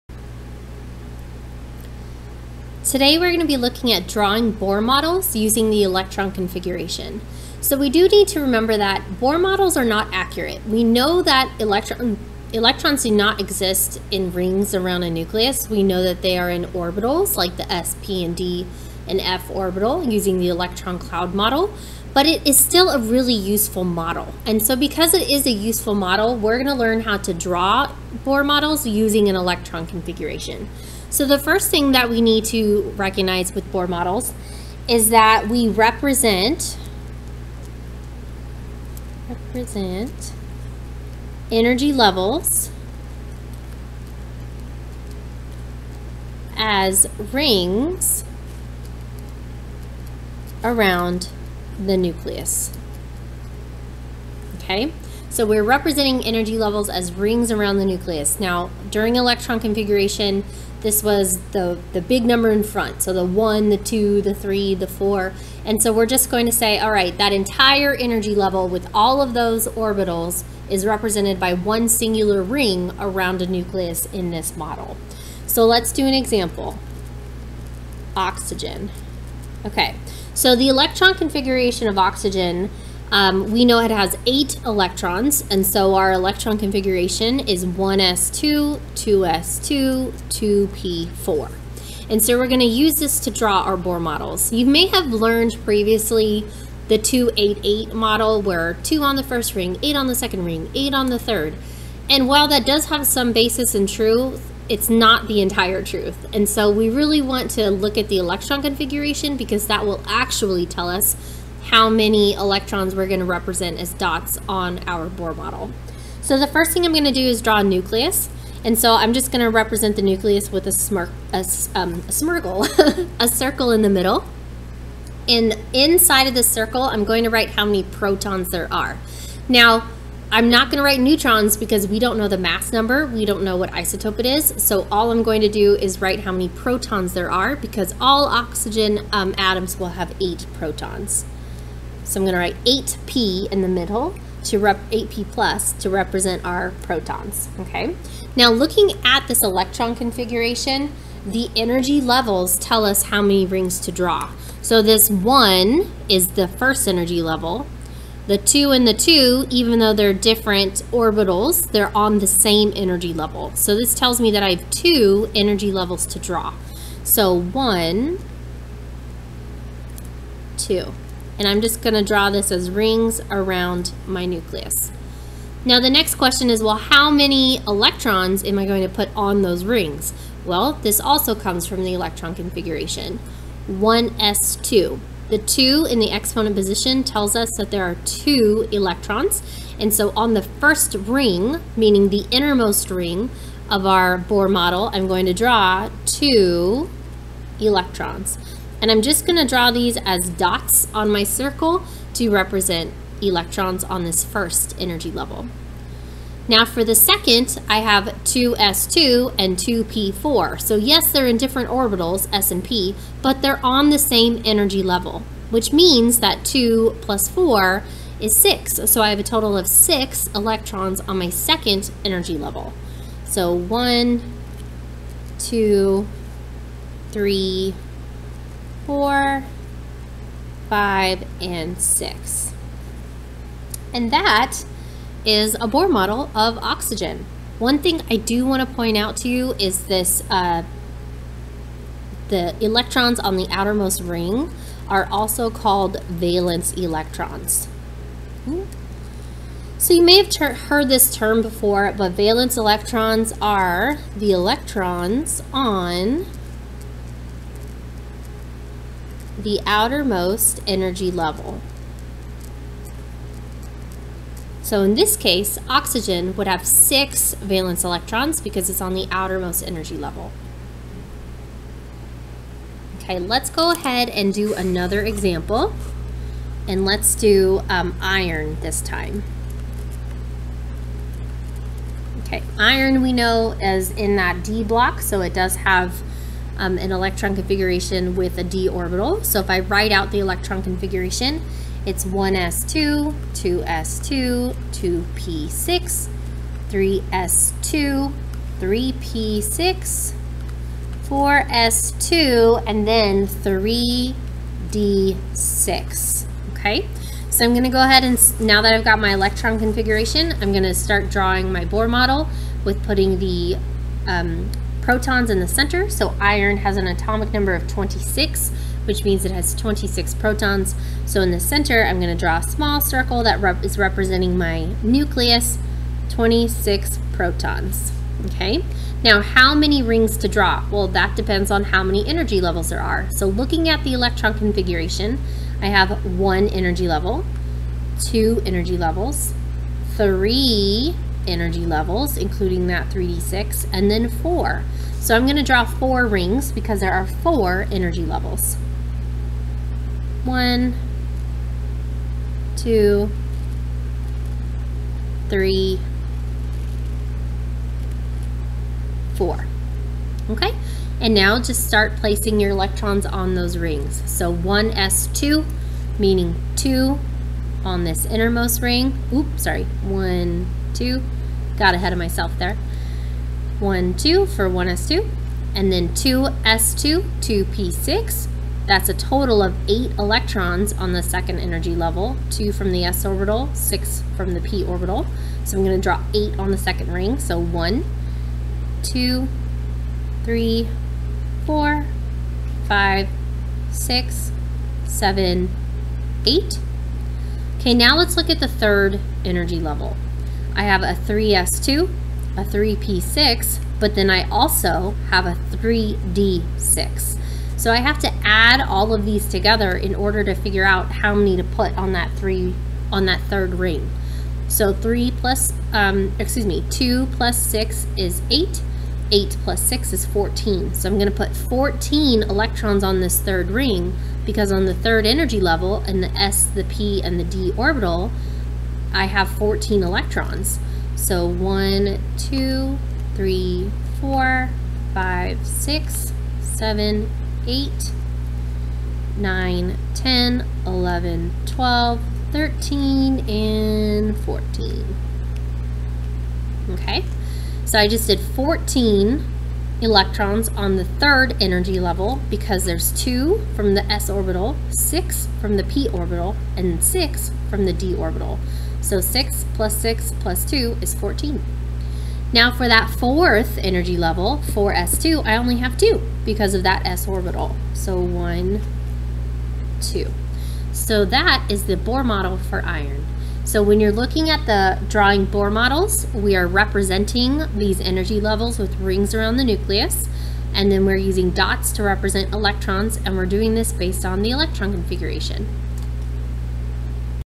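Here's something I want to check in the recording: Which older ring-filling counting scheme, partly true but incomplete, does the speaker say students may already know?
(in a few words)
288 model.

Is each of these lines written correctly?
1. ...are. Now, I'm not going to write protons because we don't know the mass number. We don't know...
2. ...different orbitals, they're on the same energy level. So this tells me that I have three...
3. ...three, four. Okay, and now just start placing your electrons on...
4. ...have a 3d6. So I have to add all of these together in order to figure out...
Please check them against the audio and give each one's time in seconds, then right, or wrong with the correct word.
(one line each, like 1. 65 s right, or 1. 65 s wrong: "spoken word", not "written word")
1. 128 s wrong: "neutrons", not "protons"
2. 160 s wrong: "two", not "three"
3. 355 s right
4. 405 s right.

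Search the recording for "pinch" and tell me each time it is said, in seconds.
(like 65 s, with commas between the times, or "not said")
not said.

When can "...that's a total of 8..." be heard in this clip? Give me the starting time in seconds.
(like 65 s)
378 s.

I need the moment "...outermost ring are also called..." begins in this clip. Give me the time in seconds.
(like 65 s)
243 s.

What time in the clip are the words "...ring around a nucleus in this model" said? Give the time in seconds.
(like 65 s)
72 s.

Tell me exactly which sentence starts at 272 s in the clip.
Okay, let's go ahead and do another example.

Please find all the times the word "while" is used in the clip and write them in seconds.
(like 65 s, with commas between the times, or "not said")
102 s.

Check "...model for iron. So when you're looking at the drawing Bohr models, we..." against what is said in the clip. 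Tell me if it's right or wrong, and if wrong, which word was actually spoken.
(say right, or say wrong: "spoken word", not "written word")
right.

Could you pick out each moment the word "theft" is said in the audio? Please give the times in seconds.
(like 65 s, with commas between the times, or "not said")
not said.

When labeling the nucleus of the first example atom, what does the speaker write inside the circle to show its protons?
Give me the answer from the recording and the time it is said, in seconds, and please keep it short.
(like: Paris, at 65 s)
8p+, at 144 s.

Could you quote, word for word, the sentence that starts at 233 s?
And that is a Bohr model of oxygen.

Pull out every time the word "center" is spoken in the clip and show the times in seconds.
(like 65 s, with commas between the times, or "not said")
315 s, 321 s.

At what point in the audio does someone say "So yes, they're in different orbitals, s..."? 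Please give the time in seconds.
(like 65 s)
210 s.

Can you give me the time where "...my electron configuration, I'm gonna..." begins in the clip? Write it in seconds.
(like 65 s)
308 s.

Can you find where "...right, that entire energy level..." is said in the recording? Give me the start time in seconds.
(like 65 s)
66 s.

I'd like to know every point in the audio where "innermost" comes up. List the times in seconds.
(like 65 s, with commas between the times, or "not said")
192 s, 368 s.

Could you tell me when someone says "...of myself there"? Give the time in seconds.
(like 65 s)
371 s.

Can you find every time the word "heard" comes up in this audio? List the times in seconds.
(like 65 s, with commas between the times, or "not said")
250 s.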